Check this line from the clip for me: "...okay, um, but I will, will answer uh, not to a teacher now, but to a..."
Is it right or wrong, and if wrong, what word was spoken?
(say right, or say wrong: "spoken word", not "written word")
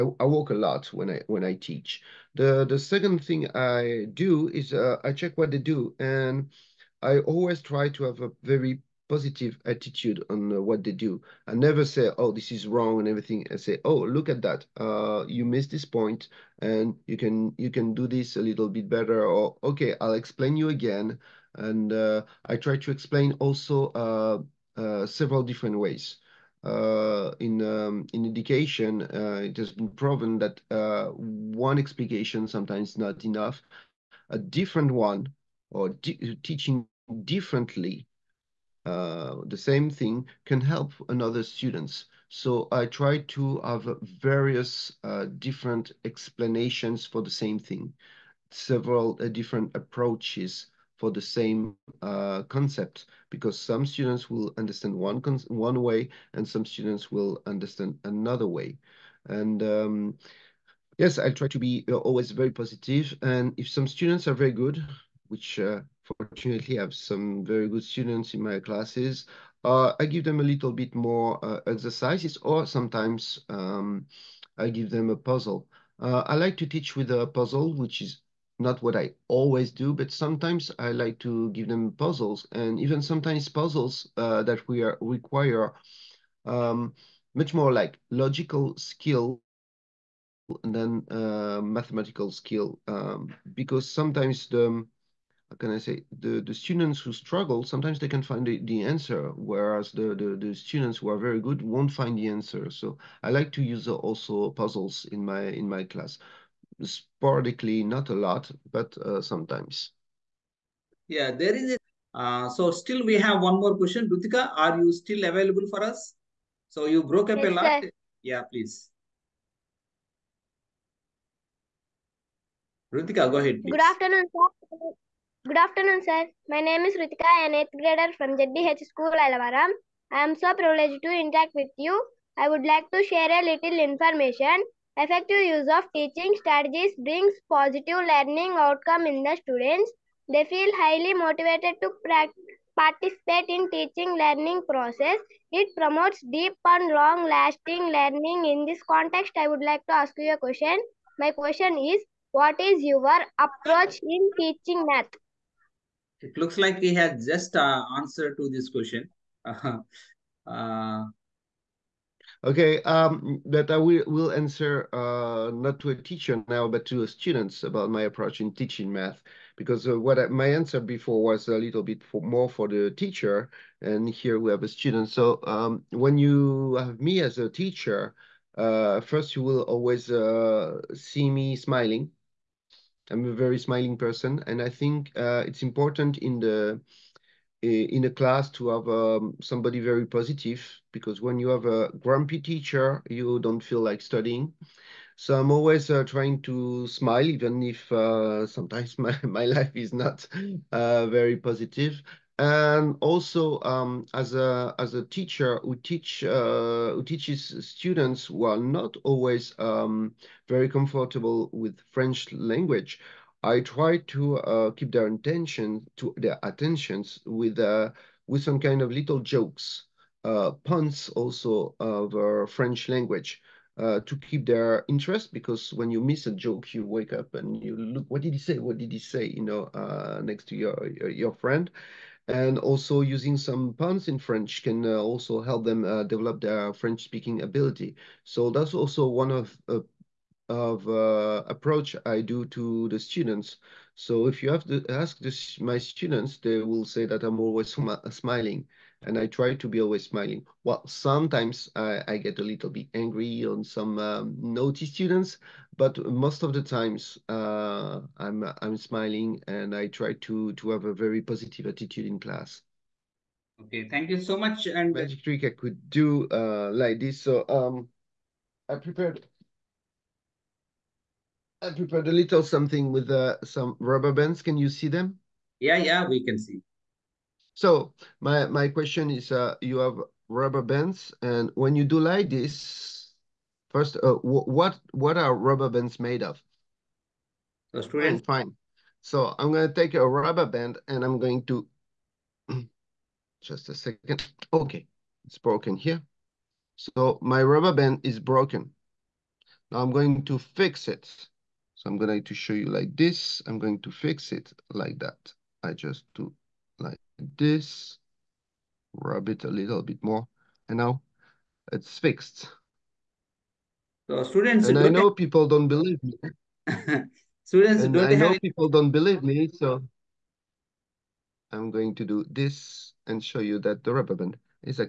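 right.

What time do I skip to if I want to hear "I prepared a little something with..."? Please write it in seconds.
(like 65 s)
271 s.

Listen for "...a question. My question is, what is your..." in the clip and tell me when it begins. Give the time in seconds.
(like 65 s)
150 s.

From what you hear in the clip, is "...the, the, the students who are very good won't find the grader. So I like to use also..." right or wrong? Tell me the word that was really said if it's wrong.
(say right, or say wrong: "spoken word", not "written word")
wrong: "answer", not "grader".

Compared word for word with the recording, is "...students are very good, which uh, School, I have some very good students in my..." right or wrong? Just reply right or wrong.
wrong.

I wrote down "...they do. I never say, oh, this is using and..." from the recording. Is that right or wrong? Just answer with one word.
wrong.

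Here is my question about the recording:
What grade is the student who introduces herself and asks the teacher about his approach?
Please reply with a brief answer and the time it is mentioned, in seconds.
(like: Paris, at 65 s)
8th grade, at 127 s.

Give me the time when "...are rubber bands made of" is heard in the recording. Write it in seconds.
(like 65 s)
285 s.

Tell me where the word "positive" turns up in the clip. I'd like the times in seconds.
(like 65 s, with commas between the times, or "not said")
9 s, 62 s, 137 s, 190 s, 201 s, 261 s.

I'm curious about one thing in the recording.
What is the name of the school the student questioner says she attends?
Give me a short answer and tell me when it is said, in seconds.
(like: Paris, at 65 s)
JDH School, at 128 s.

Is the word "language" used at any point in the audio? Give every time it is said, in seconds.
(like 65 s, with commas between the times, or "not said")
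212 s, 222 s.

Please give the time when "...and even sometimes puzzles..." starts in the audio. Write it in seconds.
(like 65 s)
82 s.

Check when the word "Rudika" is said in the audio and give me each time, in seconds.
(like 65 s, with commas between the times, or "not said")
114 s, 122 s.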